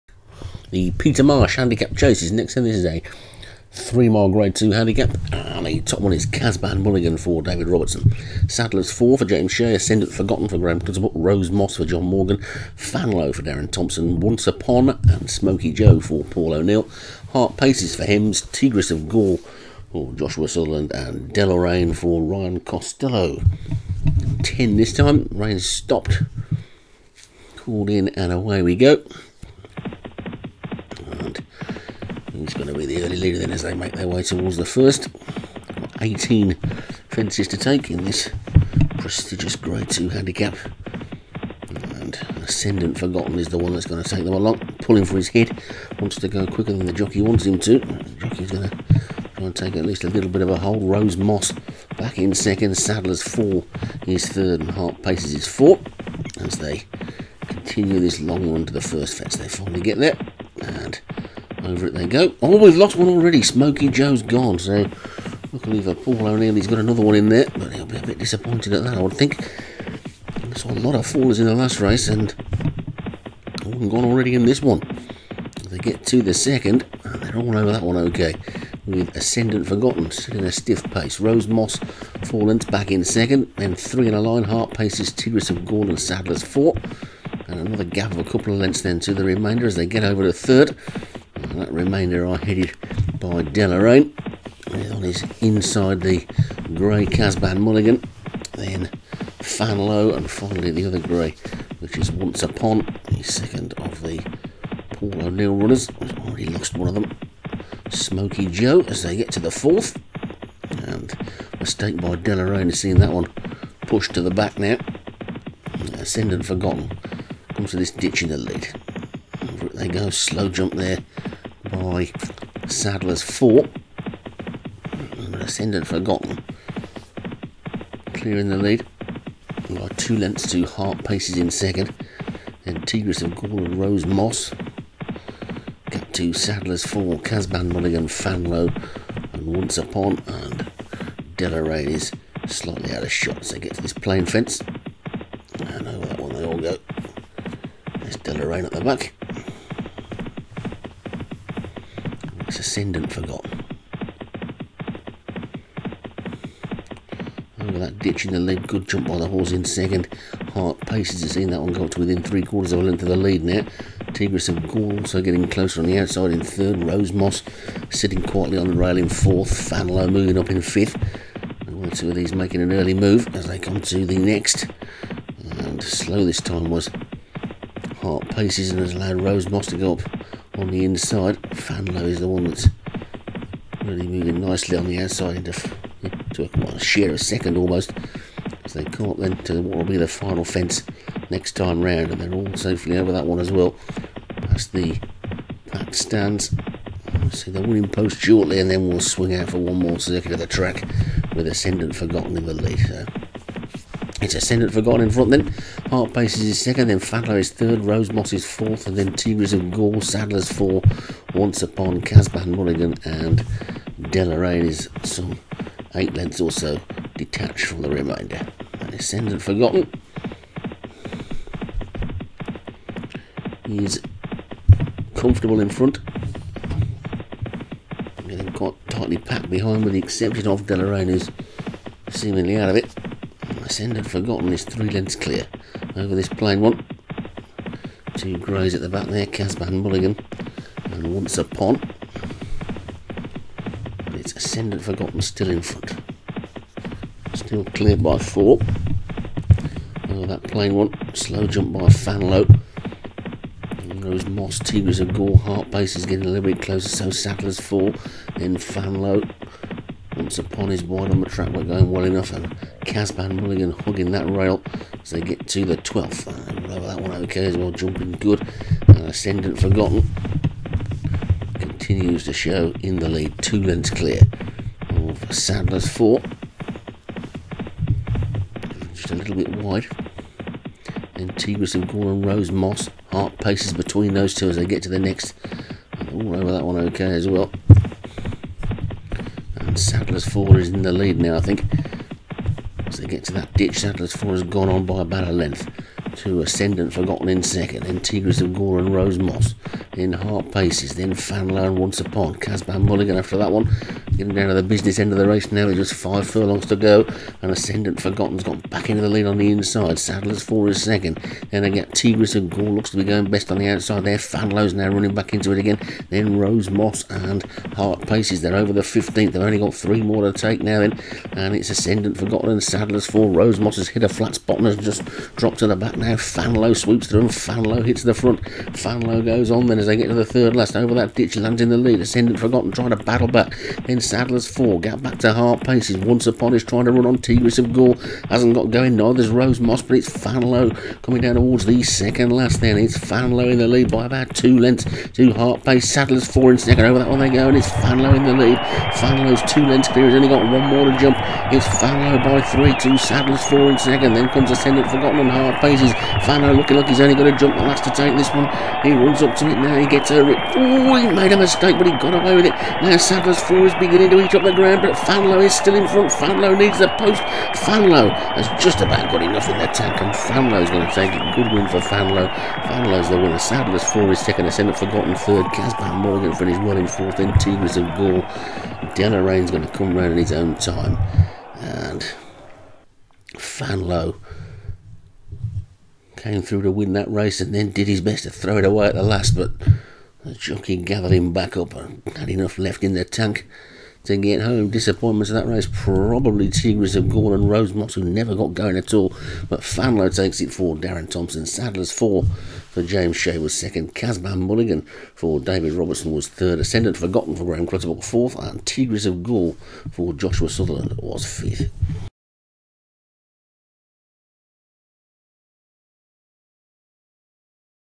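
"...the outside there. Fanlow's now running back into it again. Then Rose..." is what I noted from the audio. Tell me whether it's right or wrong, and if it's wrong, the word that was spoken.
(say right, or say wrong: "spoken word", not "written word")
right.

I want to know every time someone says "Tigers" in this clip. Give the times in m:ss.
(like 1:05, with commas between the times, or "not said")
3:29, 4:14.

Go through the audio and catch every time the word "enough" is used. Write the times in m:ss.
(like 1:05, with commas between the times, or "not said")
4:22, 6:09, 6:32.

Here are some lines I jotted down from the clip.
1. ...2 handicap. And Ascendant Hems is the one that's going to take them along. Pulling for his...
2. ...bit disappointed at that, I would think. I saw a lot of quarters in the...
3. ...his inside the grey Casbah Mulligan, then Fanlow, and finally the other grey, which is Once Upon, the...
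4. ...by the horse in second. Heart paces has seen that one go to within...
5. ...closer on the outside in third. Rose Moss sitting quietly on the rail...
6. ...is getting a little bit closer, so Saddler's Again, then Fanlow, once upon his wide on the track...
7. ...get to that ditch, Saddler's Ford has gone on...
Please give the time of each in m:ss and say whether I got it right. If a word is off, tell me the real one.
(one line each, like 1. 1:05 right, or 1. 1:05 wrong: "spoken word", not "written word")
1. 0:39 wrong: "Forgotten", not "Hems"
2. 1:08 wrong: "fallers", not "quarters"
3. 1:35 right
4. 2:39 right
5. 2:45 right
6. 4:15 wrong: "Fall", not "Again"
7. 4:53 right.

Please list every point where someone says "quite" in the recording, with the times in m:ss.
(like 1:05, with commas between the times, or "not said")
3:48.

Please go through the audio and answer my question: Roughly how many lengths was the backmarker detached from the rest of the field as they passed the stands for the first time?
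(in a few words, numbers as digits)
8.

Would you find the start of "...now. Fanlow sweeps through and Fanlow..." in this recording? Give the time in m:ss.
5:25.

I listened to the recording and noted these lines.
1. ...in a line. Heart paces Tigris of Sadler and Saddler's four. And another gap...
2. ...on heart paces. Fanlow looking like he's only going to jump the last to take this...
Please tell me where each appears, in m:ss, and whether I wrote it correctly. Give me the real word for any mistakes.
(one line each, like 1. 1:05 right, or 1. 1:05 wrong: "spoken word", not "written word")
1. 1:24 wrong: "Gaul", not "Sadler"
2. 5:55 right.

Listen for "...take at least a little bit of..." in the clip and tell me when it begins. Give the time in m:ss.
0:49.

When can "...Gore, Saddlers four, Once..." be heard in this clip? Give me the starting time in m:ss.
3:29.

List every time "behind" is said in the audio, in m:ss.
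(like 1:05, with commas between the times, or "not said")
3:49.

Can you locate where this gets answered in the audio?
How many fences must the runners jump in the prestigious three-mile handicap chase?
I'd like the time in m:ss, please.
0:36.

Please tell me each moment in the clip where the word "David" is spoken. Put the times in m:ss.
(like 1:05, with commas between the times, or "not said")
0:07, 6:45.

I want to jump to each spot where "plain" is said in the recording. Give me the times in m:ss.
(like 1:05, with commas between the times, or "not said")
3:56, 4:10.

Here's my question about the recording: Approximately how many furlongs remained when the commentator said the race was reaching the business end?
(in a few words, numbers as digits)
5.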